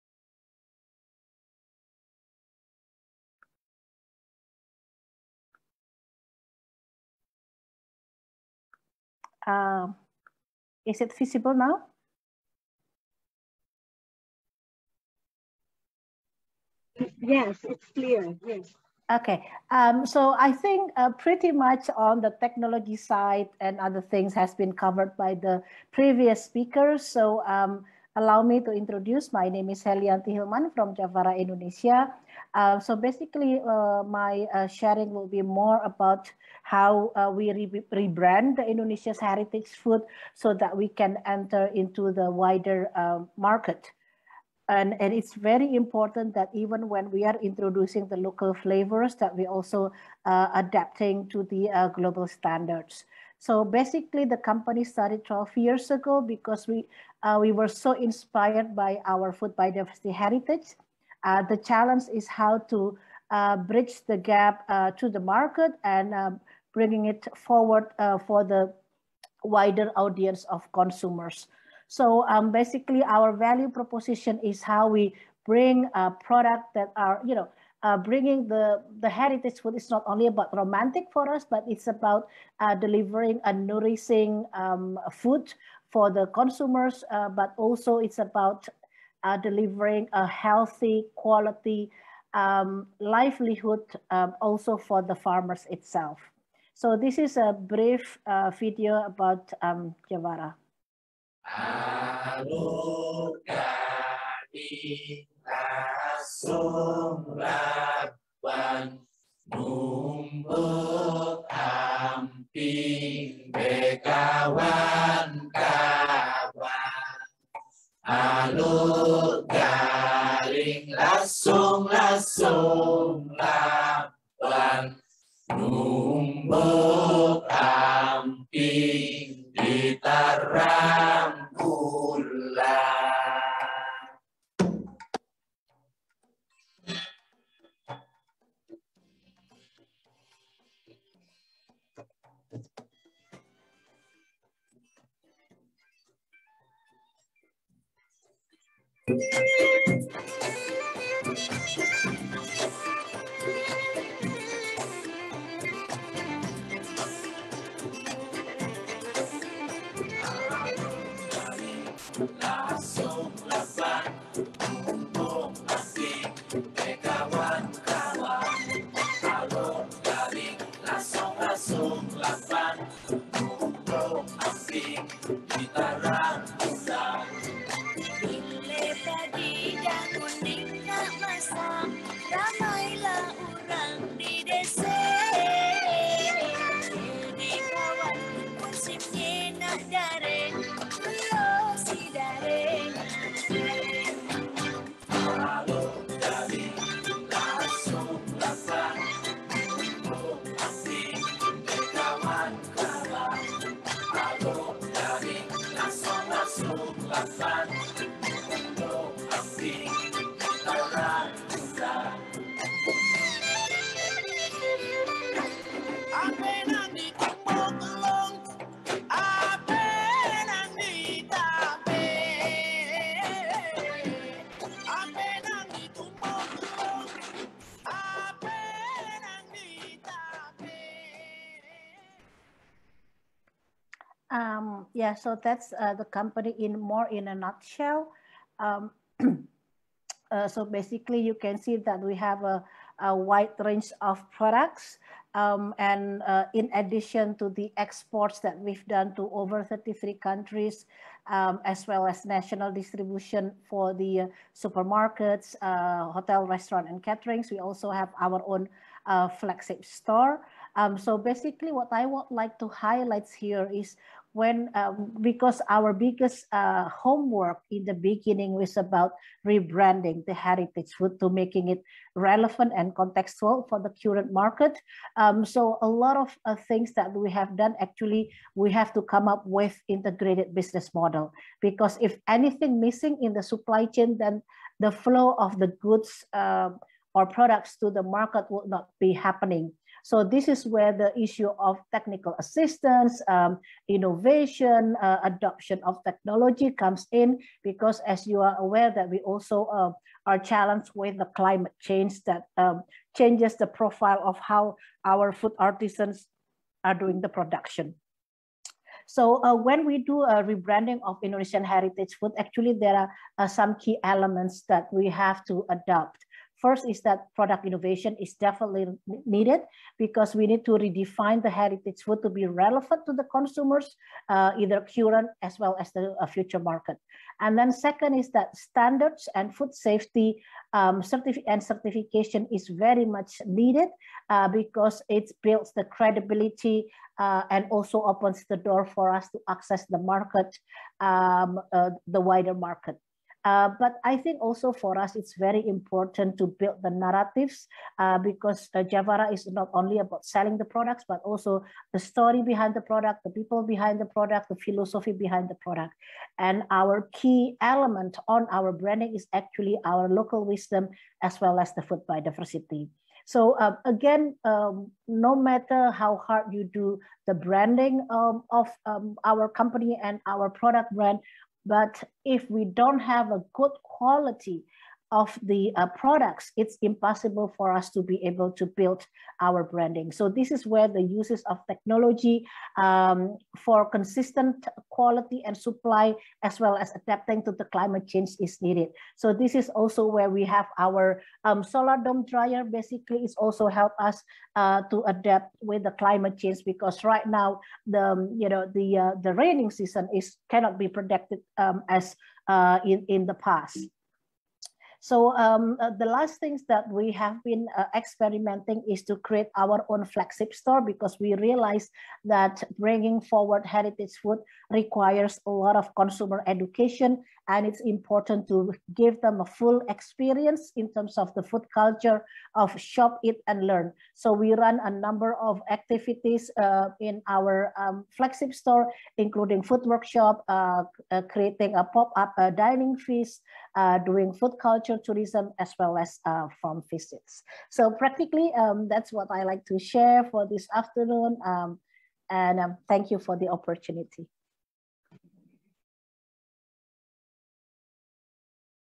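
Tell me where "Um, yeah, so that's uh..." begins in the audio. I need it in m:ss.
3:54.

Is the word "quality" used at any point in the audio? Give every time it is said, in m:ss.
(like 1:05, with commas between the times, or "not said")
1:31, 6:13, 6:24.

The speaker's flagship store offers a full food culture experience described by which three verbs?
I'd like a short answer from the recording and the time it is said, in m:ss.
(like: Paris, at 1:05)
Shop, eat, and learn, at 7:02.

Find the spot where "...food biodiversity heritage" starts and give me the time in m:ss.
0:59.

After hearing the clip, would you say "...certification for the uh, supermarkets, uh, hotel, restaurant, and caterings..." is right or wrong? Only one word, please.
wrong.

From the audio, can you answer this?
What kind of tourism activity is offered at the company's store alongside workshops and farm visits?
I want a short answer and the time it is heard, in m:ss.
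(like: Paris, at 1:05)
Food culture tourism, at 7:14.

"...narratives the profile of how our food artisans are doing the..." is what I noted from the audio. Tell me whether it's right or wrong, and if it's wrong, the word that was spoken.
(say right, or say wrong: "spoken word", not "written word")
wrong: "changes", not "narratives".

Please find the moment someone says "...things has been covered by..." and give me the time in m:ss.
0:24.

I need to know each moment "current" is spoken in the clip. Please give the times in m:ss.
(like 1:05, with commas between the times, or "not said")
4:34, 5:24.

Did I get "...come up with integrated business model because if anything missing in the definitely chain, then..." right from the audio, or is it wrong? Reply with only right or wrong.
wrong.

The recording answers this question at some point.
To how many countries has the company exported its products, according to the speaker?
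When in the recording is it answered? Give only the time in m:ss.
4:09.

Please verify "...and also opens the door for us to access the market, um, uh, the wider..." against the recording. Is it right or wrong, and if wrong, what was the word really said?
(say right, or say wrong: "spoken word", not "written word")
right.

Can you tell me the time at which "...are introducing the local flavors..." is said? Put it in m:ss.
0:47.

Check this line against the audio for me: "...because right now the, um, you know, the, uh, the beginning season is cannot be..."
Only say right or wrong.
wrong.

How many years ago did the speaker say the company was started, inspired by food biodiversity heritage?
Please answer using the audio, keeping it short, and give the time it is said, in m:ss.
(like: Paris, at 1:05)
12, at 0:55.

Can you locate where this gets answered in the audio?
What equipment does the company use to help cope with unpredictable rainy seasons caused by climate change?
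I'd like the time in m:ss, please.
6:31.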